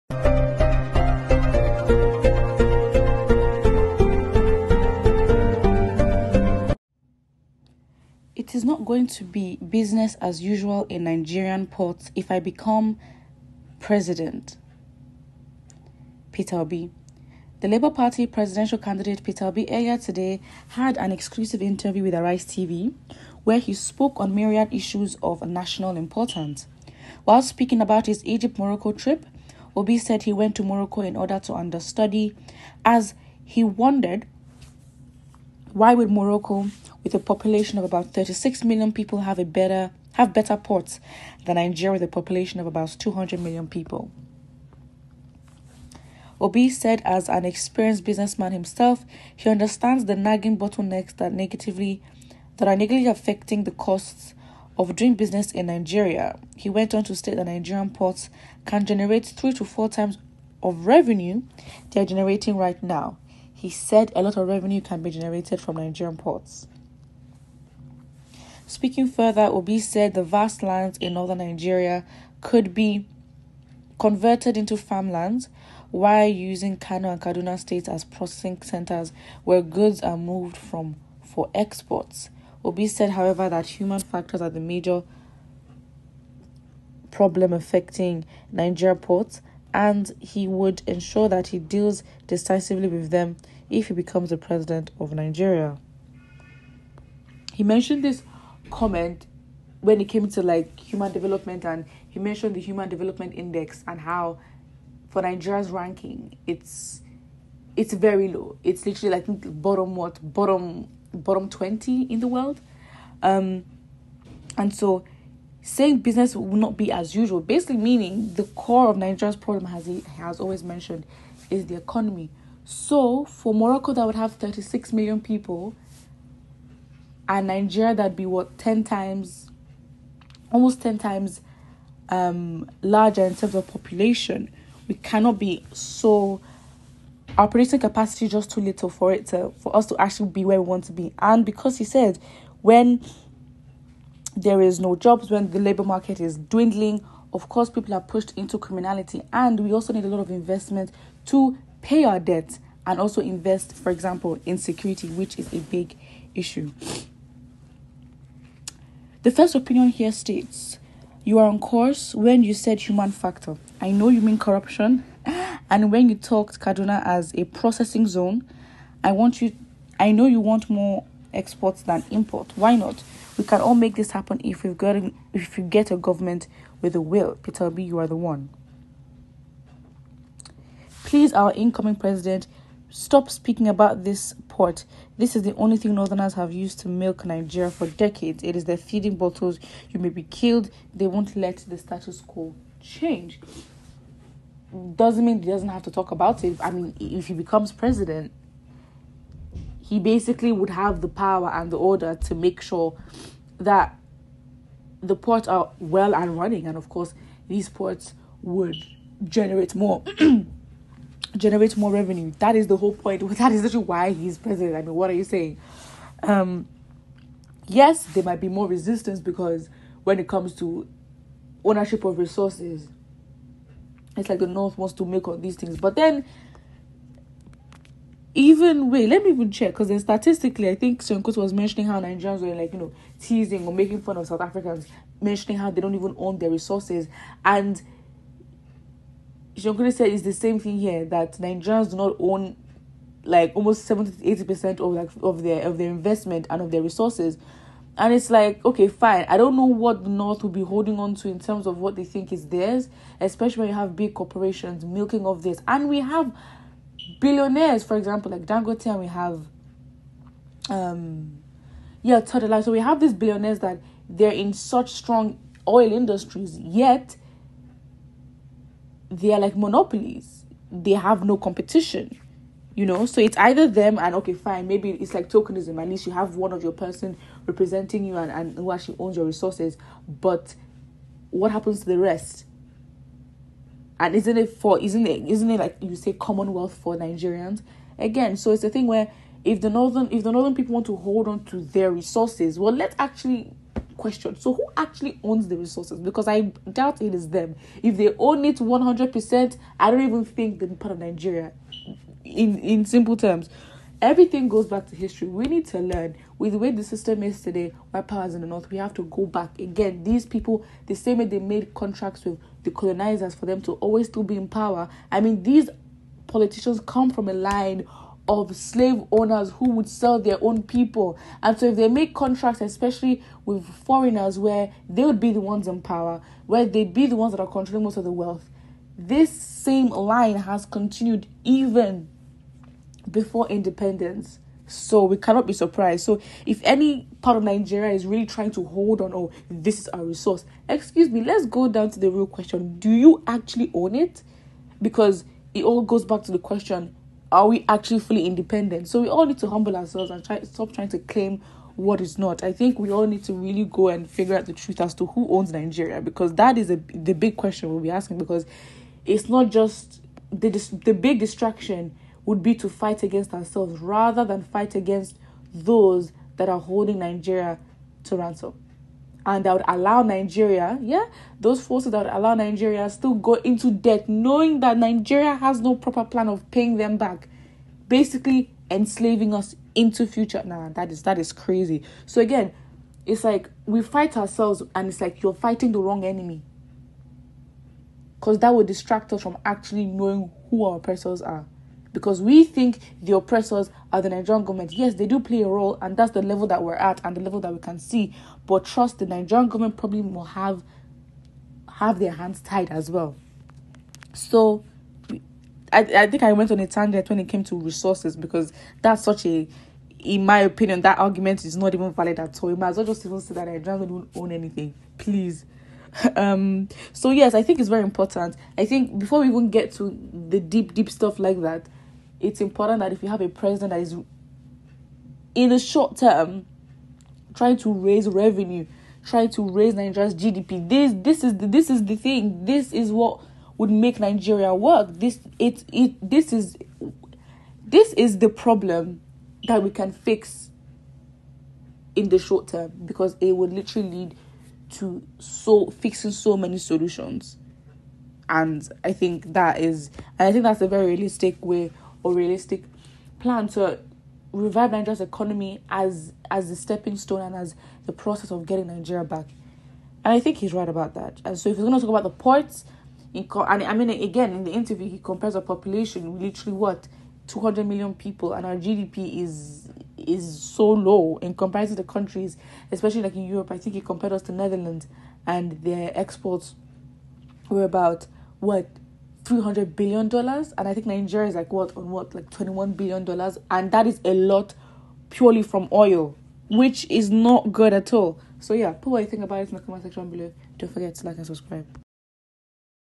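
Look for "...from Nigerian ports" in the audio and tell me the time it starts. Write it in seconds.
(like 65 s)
65 s.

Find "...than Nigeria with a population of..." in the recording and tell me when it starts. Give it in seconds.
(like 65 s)
41 s.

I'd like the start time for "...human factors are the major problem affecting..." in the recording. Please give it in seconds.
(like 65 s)
83 s.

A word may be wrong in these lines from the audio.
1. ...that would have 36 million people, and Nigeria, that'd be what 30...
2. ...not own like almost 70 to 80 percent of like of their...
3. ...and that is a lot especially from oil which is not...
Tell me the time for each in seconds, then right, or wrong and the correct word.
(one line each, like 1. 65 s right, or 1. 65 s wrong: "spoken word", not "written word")
1. 123 s wrong: "10", not "30"
2. 241 s right
3. 483 s wrong: "purely", not "especially".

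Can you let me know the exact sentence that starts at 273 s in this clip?
So it's either them and okay, fine, maybe it's like tokenism.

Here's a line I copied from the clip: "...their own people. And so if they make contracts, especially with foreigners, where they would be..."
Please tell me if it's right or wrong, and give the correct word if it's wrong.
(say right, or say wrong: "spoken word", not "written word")
right.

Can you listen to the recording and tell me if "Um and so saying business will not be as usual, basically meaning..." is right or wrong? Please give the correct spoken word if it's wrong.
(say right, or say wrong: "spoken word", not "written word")
right.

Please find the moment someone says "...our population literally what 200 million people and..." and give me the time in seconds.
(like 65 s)
465 s.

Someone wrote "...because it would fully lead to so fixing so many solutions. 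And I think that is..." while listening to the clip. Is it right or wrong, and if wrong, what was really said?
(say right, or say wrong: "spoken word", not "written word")
wrong: "literally", not "fully".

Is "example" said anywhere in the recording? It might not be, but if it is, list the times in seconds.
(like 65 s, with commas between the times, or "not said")
153 s, 257 s.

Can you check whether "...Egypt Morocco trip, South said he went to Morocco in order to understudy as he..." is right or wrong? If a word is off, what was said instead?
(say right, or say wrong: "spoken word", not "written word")
wrong: "Obi", not "South".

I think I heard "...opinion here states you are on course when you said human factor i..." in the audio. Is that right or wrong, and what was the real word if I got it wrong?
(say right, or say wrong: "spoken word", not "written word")
right.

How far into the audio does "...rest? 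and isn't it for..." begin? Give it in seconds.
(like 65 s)
281 s.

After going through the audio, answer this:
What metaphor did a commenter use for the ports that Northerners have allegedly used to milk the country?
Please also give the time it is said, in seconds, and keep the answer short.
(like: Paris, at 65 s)
Feeding bottles, at 188 s.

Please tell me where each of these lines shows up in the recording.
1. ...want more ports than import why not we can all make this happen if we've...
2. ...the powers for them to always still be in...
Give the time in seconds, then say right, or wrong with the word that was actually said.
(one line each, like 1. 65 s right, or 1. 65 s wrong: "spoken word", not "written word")
1. 170 s wrong: "exports", not "ports"
2. 312 s wrong: "colonizers", not "powers".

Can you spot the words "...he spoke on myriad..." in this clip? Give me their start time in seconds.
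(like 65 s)
23 s.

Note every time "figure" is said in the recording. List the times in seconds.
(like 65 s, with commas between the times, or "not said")
354 s.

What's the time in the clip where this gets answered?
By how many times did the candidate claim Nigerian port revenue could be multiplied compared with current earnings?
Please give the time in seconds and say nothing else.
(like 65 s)
59 s.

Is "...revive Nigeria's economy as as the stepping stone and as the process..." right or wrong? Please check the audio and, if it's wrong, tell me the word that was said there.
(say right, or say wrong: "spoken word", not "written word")
right.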